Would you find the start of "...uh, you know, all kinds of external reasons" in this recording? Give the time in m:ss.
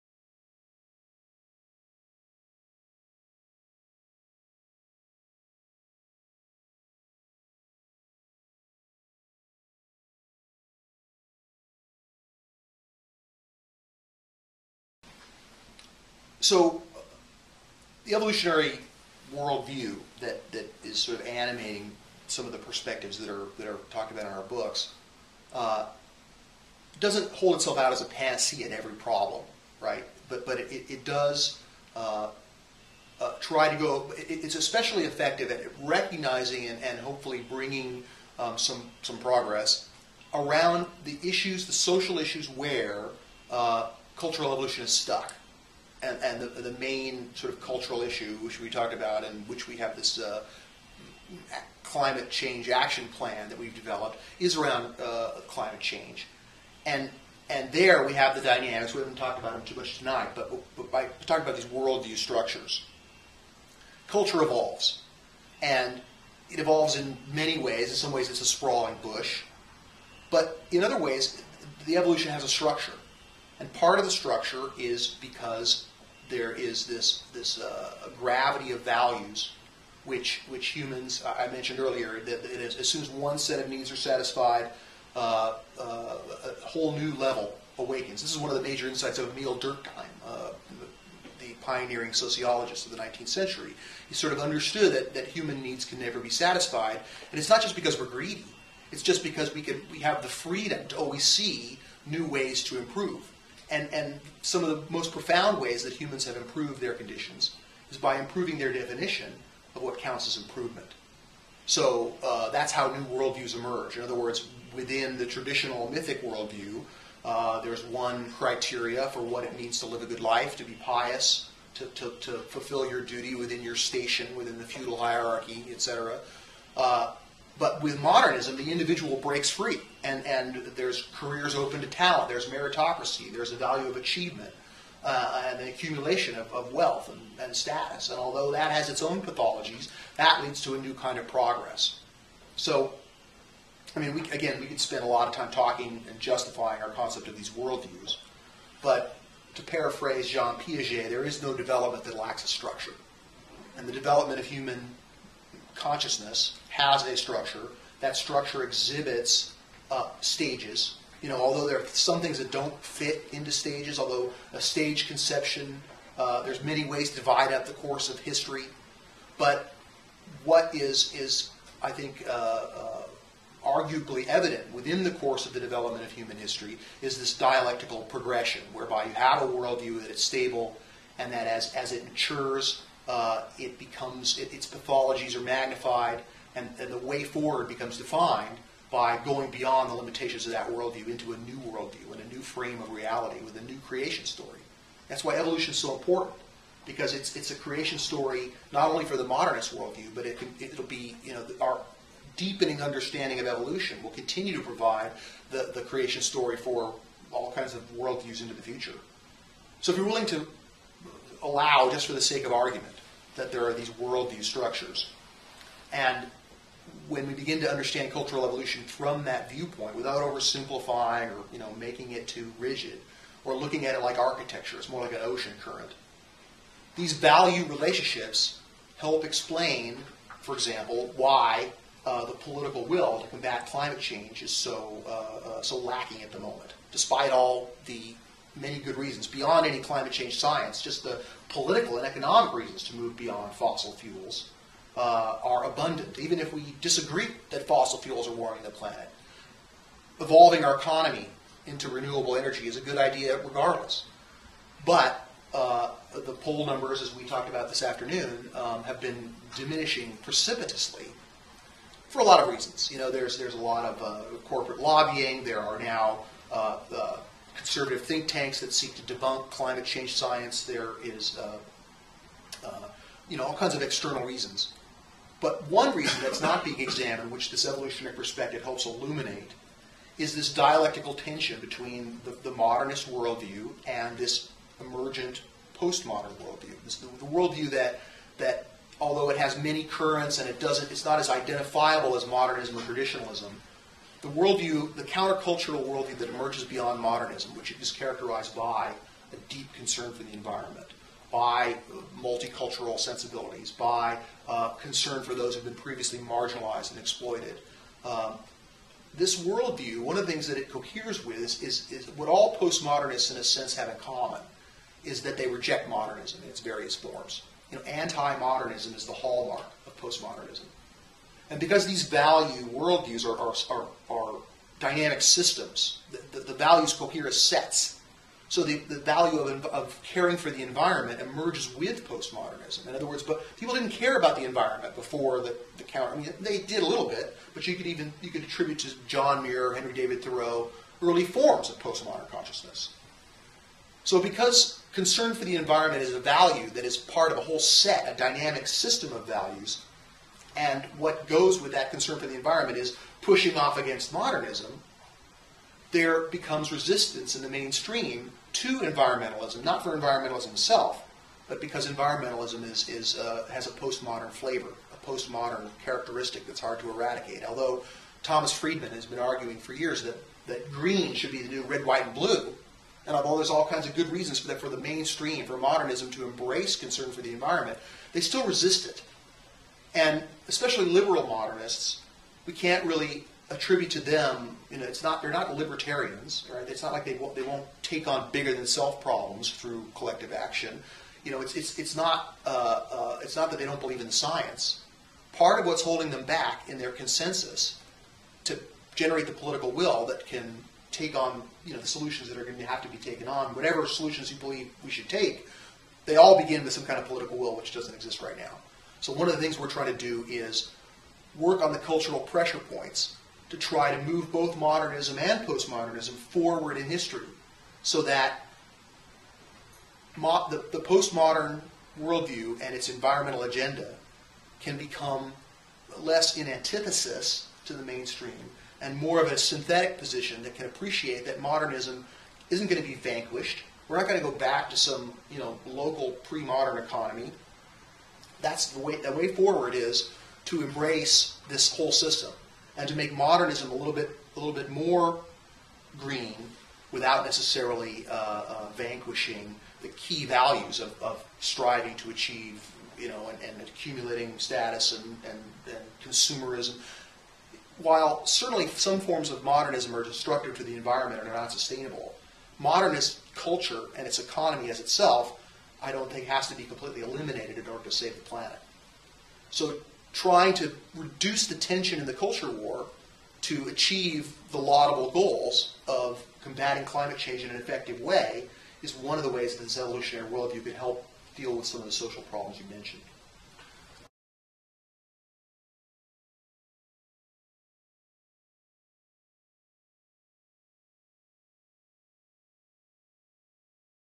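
4:32.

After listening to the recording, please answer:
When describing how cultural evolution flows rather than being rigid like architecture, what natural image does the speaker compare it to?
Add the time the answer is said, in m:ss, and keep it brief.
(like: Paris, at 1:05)
an ocean current, at 3:45.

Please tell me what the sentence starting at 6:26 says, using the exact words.
It's not like they won't, they won't take on bigger than self problems through collective action.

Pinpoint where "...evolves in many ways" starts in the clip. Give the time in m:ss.
1:06.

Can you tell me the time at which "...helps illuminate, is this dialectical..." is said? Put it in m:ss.
4:38.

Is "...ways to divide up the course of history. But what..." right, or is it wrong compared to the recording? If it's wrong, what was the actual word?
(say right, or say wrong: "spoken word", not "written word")
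right.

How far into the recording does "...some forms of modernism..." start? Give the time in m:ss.
7:38.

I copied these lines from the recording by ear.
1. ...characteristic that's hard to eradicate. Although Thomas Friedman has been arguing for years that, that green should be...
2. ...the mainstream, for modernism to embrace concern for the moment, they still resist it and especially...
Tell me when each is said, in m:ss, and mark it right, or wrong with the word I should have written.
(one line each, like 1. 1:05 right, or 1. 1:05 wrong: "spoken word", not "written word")
1. 6:05 right
2. 6:14 wrong: "environment", not "moment".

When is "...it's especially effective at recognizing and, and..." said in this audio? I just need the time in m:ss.
0:34.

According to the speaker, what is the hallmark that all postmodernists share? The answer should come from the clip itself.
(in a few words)
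anti-modernism.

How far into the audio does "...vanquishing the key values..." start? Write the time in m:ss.
7:28.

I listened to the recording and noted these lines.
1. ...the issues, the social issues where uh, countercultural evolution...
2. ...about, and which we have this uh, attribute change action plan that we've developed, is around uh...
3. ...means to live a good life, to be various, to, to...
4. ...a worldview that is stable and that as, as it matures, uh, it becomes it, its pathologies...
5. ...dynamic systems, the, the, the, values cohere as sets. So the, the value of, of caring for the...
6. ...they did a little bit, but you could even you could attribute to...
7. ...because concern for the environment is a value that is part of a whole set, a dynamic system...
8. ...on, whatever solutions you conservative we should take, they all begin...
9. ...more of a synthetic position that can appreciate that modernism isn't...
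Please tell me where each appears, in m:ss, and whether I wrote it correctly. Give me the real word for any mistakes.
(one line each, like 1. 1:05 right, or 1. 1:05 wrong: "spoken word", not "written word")
1. 0:41 wrong: "cultural", not "countercultural"
2. 0:48 wrong: "climate", not "attribute"
3. 1:59 wrong: "pious", not "various"
4. 2:59 right
5. 5:24 right
6. 5:36 right
7. 5:44 right
8. 6:43 wrong: "believe", not "conservative"
9. 7:09 right.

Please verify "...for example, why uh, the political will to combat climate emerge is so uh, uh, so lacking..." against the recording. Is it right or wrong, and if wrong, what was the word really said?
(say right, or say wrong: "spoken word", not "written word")
wrong: "change", not "emerge".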